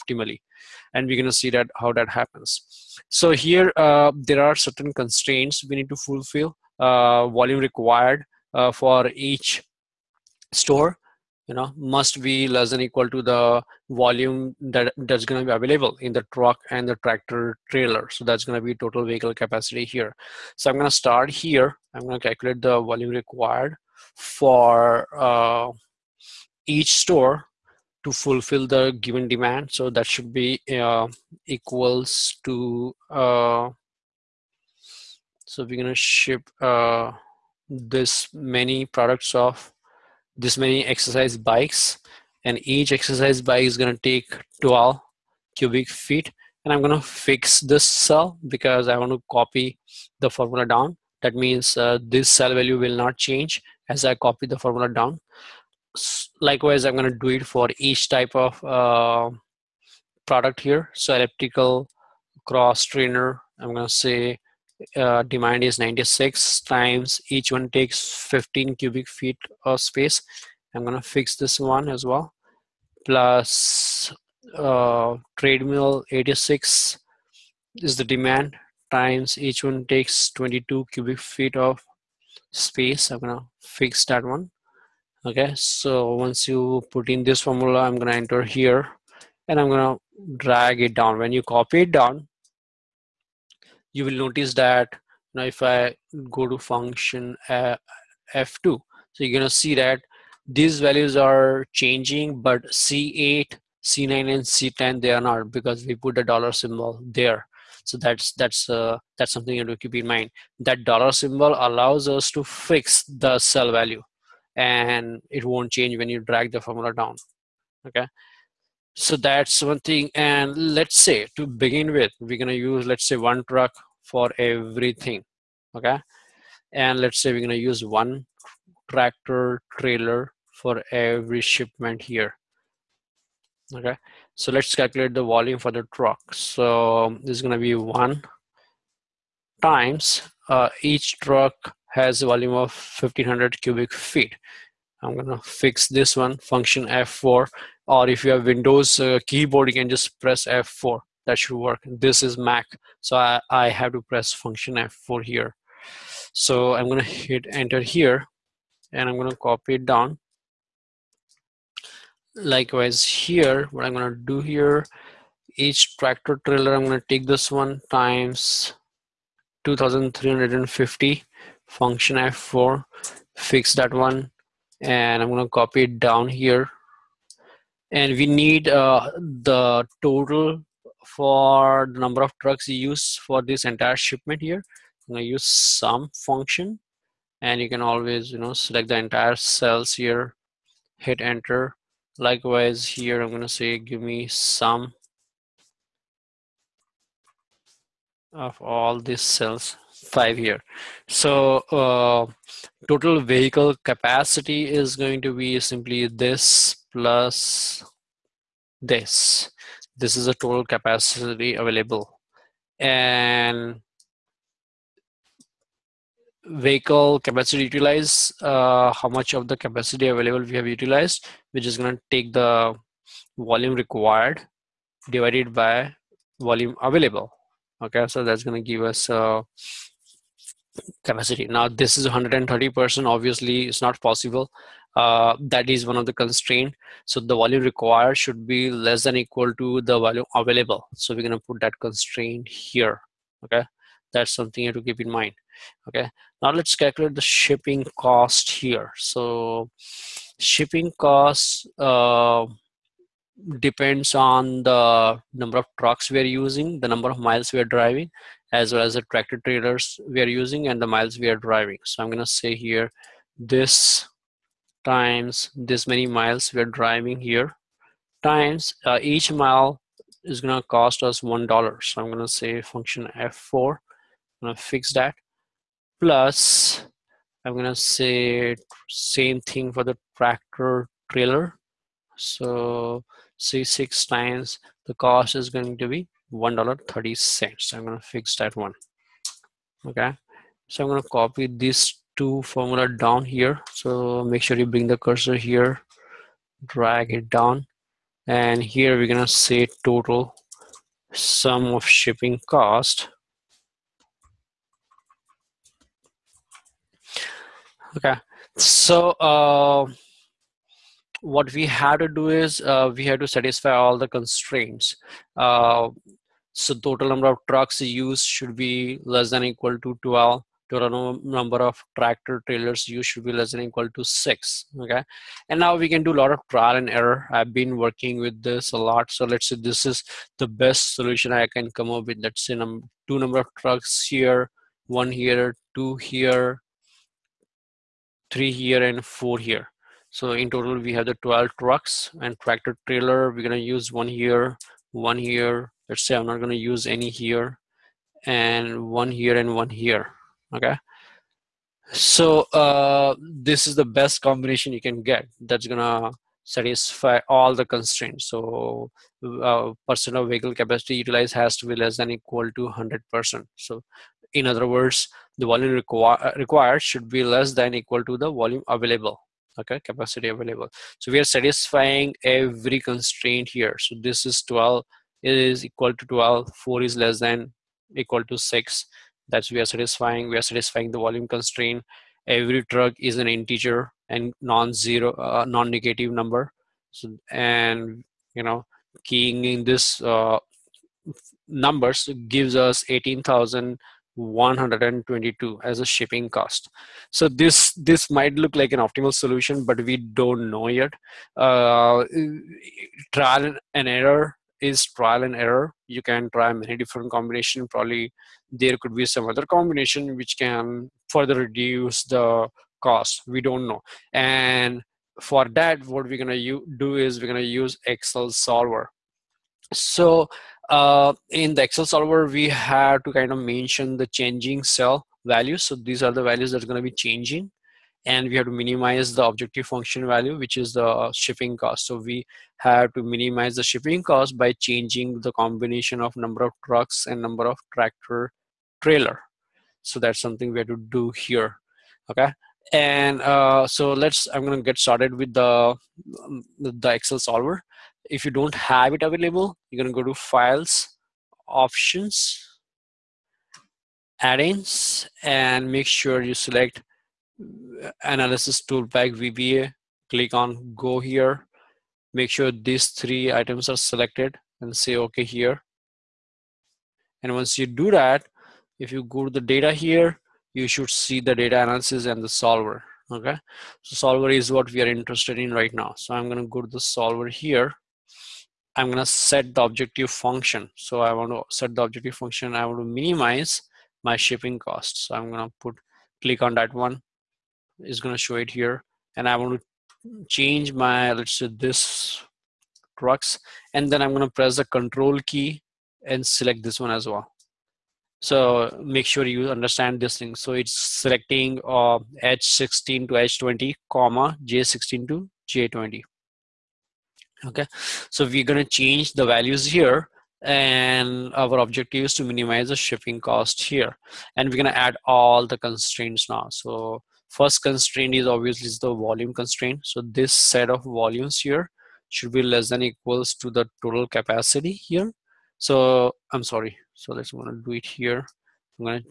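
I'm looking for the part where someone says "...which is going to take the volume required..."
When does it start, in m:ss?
3:41.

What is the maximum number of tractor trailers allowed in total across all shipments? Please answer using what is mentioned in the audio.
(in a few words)
6.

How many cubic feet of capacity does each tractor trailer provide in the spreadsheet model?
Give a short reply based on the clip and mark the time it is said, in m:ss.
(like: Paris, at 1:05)
2350, at 2:49.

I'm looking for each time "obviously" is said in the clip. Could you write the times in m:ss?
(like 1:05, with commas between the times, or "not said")
3:53, 8:38.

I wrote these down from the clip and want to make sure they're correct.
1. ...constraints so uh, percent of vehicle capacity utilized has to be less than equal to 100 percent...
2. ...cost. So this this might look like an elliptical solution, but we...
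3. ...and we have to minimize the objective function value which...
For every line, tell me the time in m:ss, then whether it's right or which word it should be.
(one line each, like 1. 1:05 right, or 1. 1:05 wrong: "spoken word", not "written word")
1. 5:57 right
2. 6:36 wrong: "optimal", not "elliptical"
3. 7:08 right.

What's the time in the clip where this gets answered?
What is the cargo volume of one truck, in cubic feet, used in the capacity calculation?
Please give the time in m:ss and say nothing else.
2:23.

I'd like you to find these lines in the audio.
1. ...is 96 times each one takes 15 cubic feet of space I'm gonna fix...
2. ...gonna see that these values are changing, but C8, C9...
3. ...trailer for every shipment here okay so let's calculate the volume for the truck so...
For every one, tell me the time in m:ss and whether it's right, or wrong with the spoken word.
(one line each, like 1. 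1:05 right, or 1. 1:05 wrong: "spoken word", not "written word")
1. 1:05 right
2. 1:39 right
3. 2:09 right.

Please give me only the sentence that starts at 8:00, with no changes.
So I want to set the objective function.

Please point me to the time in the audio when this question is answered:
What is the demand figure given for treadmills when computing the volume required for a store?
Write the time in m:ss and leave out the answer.
1:15.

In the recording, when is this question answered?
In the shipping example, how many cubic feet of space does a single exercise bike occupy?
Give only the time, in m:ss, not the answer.
0:44.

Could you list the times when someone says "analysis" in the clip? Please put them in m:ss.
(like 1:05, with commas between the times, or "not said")
7:38, 7:51.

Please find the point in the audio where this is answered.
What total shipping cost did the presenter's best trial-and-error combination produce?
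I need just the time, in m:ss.
6:32.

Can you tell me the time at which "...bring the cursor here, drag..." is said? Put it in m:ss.
4:54.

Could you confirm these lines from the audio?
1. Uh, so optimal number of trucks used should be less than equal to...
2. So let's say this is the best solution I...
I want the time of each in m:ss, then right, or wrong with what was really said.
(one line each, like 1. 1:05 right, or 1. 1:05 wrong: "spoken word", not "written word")
1. 5:15 wrong: "total", not "optimal"
2. 5:29 right.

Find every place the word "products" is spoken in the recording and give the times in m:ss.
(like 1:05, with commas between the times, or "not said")
0:38, 1:00.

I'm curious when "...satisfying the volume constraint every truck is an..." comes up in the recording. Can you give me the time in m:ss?
6:20.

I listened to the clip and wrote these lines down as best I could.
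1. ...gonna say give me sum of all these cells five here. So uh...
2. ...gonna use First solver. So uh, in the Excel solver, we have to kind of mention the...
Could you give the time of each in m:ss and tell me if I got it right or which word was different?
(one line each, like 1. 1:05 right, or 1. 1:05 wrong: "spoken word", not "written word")
1. 3:13 right
2. 6:57 wrong: "Excel", not "First".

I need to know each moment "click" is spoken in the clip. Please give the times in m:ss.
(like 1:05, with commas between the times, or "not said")
7:40, 8:06.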